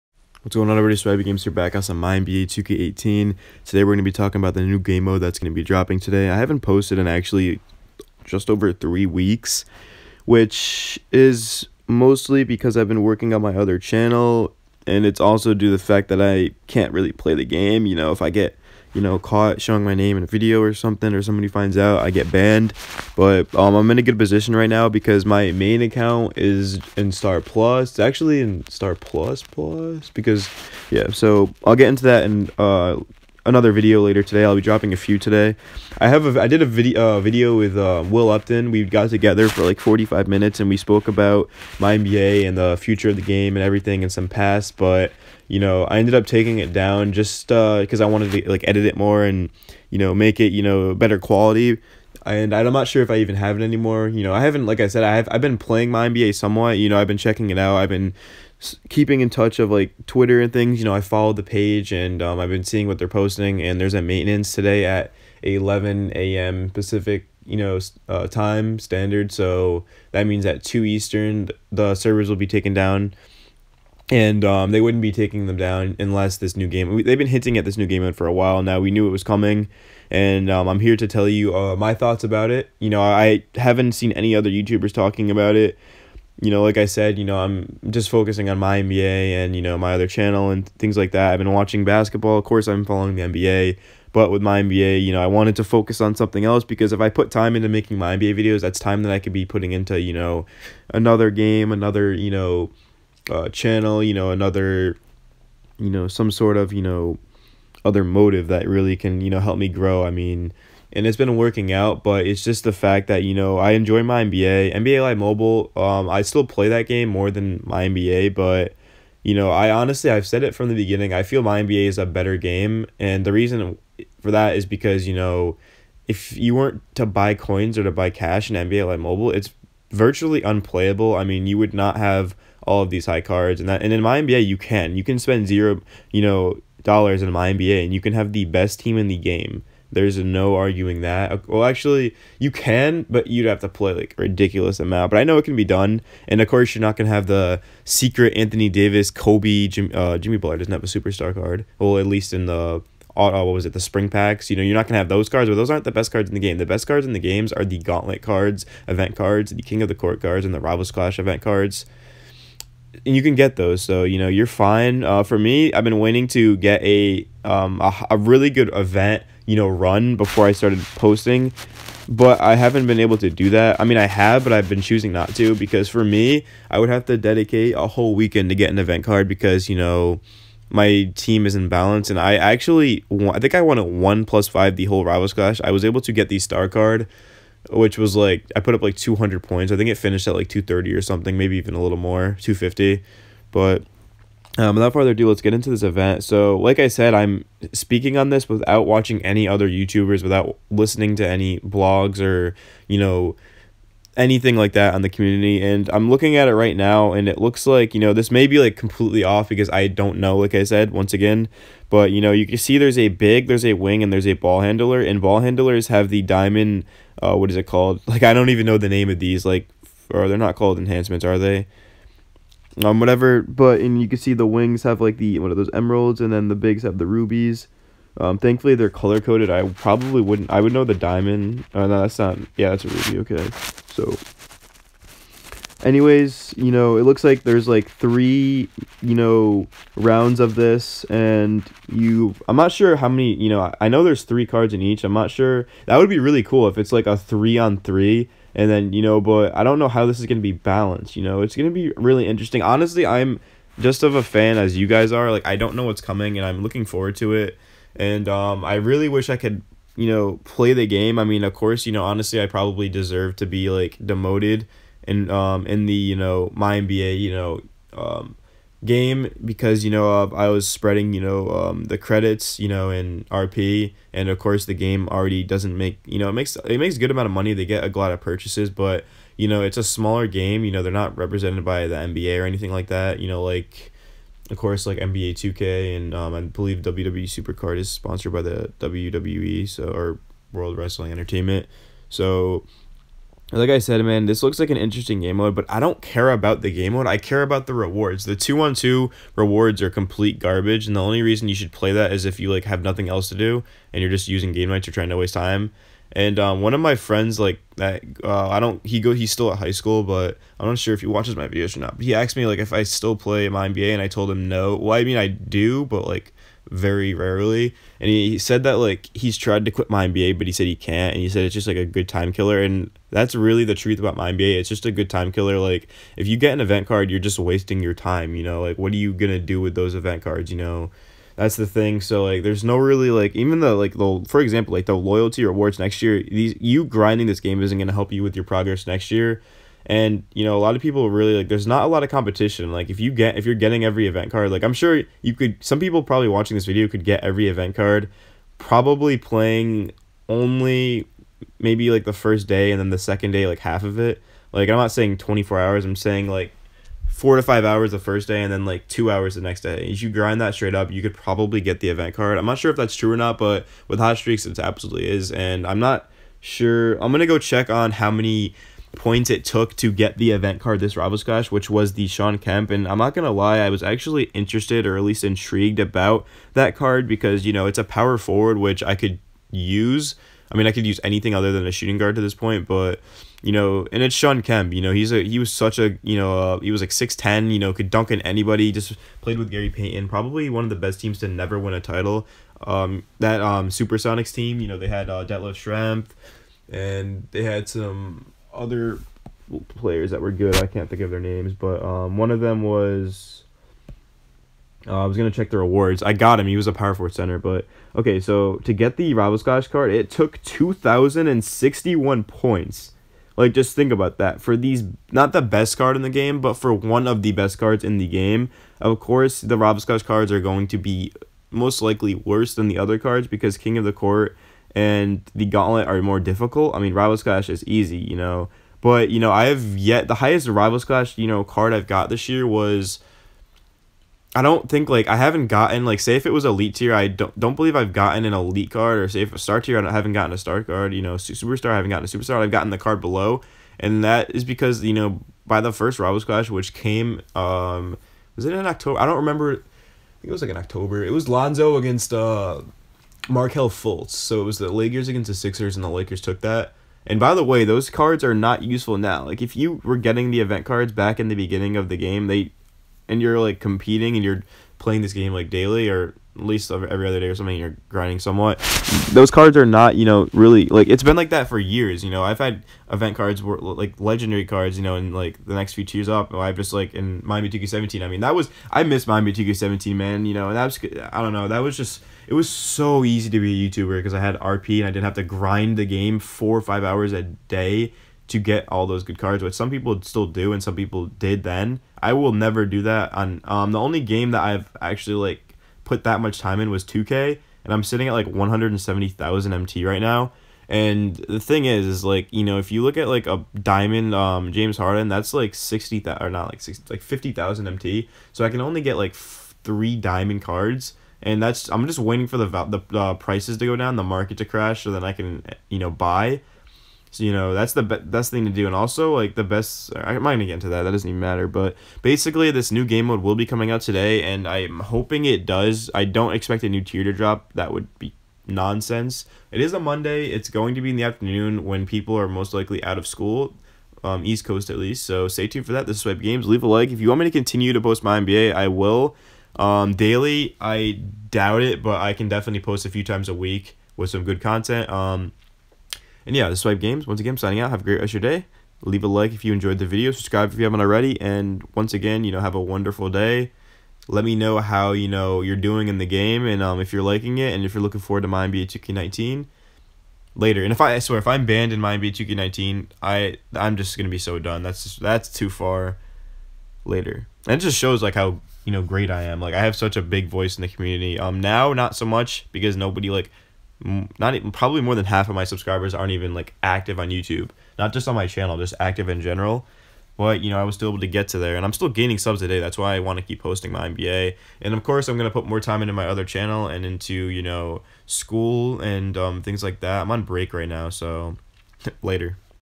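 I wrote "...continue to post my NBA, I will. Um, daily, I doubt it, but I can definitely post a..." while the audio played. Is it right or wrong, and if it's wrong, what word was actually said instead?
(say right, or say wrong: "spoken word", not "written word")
right.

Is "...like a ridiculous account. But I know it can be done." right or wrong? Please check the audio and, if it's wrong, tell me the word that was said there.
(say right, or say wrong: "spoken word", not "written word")
wrong: "amount", not "account".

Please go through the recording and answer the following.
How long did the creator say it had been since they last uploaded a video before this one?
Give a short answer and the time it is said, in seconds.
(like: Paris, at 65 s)
just over three weeks, at 8 s.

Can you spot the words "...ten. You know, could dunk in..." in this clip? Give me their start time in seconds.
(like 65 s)
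387 s.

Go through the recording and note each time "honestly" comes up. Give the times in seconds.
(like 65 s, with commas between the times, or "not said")
119 s, 252 s, 262 s.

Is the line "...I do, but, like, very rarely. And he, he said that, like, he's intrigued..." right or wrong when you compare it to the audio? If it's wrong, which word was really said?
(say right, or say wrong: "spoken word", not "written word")
wrong: "tried", not "intrigued".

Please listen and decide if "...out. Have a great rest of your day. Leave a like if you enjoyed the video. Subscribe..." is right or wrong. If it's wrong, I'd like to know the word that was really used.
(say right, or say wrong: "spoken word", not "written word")
right.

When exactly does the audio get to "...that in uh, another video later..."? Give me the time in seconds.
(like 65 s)
32 s.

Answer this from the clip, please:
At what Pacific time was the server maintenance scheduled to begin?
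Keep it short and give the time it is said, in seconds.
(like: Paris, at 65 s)
11 a.m., at 65 s.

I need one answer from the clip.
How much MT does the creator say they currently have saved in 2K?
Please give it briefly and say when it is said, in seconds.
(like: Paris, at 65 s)
170,000, at 498 s.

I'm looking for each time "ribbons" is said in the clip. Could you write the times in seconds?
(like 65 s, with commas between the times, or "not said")
not said.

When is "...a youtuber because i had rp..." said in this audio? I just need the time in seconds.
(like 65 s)
483 s.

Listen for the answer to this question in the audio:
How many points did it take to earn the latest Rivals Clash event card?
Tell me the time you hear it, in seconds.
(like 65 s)
410 s.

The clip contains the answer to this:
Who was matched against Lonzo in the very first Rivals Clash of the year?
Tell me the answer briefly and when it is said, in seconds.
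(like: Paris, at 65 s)
Markelle Fultz, at 453 s.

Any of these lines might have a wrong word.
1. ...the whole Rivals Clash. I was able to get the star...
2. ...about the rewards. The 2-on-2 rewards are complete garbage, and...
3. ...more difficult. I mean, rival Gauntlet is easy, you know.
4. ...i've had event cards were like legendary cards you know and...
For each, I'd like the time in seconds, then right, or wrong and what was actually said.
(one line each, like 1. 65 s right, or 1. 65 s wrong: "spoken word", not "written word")
1. 184 s right
2. 297 s right
3. 426 s wrong: "Clash", not "Gauntlet"
4. 472 s right.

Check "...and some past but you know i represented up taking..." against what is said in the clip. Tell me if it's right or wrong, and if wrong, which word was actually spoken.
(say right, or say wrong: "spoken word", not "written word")
wrong: "ended", not "represented".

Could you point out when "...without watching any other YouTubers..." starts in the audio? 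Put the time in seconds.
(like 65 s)
198 s.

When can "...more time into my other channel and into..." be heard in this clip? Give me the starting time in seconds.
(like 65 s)
585 s.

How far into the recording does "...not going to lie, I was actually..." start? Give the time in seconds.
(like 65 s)
372 s.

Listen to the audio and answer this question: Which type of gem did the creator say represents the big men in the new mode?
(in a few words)
rubies.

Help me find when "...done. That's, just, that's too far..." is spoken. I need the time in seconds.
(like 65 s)
564 s.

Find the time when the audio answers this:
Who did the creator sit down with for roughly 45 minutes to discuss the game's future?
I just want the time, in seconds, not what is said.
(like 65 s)
38 s.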